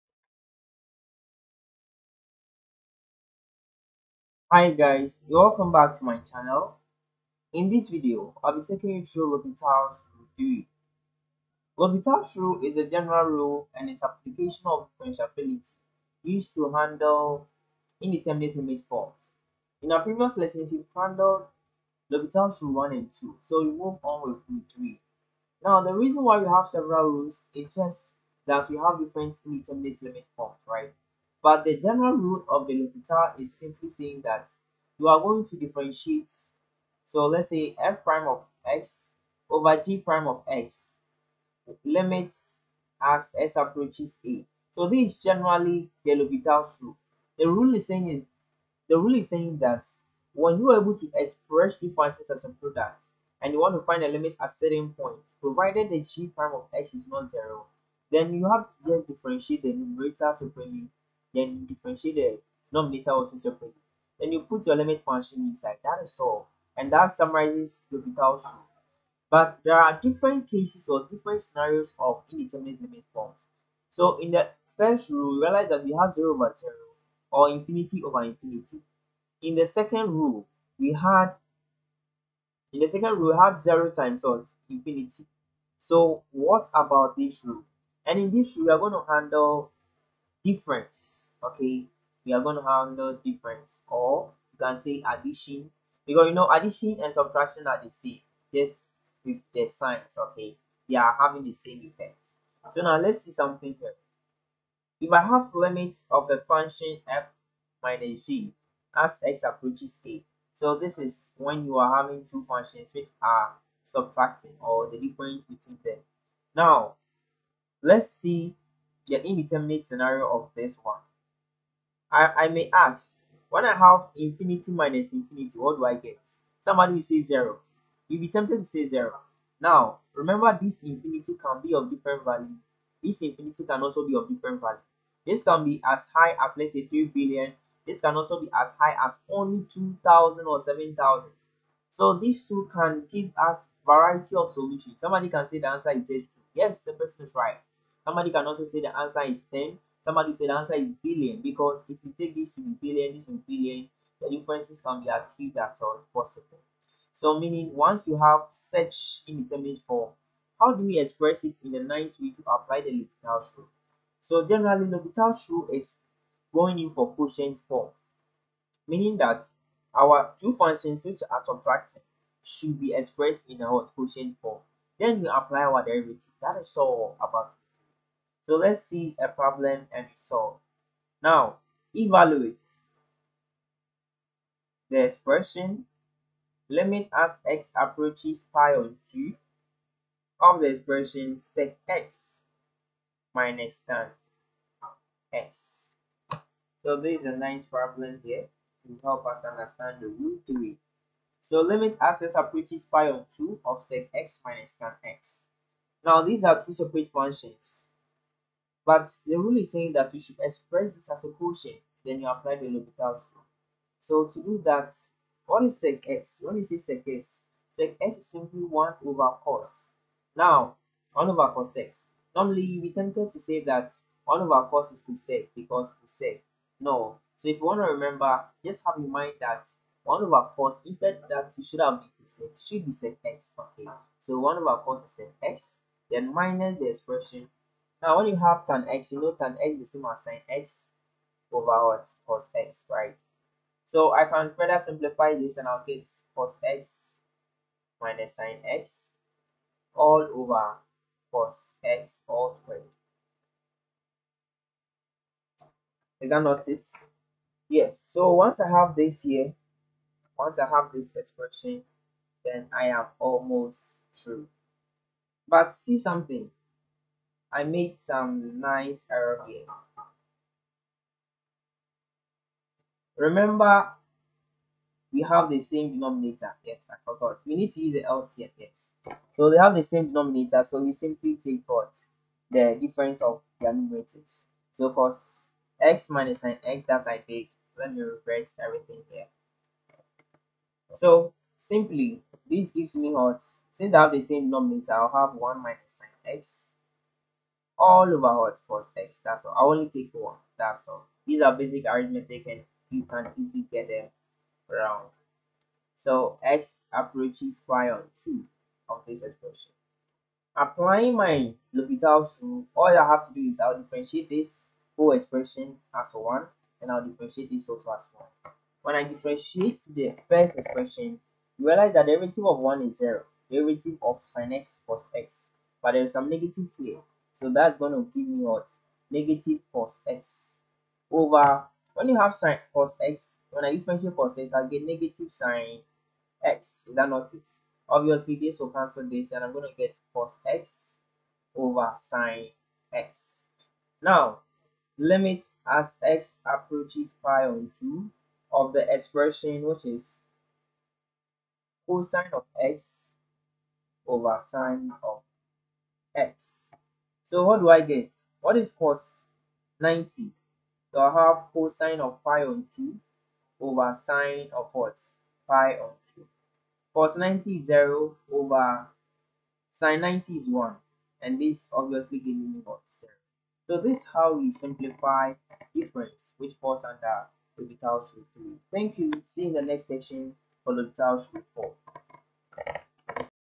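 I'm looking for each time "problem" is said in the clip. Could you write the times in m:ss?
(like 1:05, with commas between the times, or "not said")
2:59, 3:17.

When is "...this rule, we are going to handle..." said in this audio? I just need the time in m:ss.
1:28.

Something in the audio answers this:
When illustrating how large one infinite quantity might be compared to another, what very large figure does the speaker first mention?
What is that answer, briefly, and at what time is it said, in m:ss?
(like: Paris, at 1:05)
3 billion, at 2:16.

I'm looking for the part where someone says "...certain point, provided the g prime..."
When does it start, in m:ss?
0:54.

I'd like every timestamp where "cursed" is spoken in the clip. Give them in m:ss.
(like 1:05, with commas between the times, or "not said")
not said.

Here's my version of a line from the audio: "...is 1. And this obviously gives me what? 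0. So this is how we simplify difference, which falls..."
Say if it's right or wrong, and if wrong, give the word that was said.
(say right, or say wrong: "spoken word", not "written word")
right.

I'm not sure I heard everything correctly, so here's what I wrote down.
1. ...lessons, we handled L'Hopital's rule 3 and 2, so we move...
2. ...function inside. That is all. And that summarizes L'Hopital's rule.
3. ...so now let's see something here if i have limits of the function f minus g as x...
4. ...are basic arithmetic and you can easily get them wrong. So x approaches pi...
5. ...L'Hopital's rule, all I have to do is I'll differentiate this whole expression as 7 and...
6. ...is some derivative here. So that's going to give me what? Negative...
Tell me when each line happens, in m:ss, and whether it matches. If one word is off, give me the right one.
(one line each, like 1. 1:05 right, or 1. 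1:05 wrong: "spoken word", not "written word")
1. 0:20 wrong: "1", not "3"
2. 1:05 right
3. 1:42 right
4. 5:01 right
5. 5:11 wrong: "1", not "7"
6. 5:26 wrong: "negative", not "derivative".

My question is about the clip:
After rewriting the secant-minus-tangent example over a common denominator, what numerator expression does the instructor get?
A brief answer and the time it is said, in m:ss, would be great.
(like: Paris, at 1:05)
1 minus sin x, at 4:55.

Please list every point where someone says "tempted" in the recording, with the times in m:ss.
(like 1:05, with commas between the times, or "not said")
2:08, 3:42.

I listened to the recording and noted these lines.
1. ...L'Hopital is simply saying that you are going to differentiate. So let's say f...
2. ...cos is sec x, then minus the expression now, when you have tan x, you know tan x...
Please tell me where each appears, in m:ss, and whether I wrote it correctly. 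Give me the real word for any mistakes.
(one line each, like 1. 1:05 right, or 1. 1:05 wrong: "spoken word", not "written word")
1. 0:32 right
2. 3:54 right.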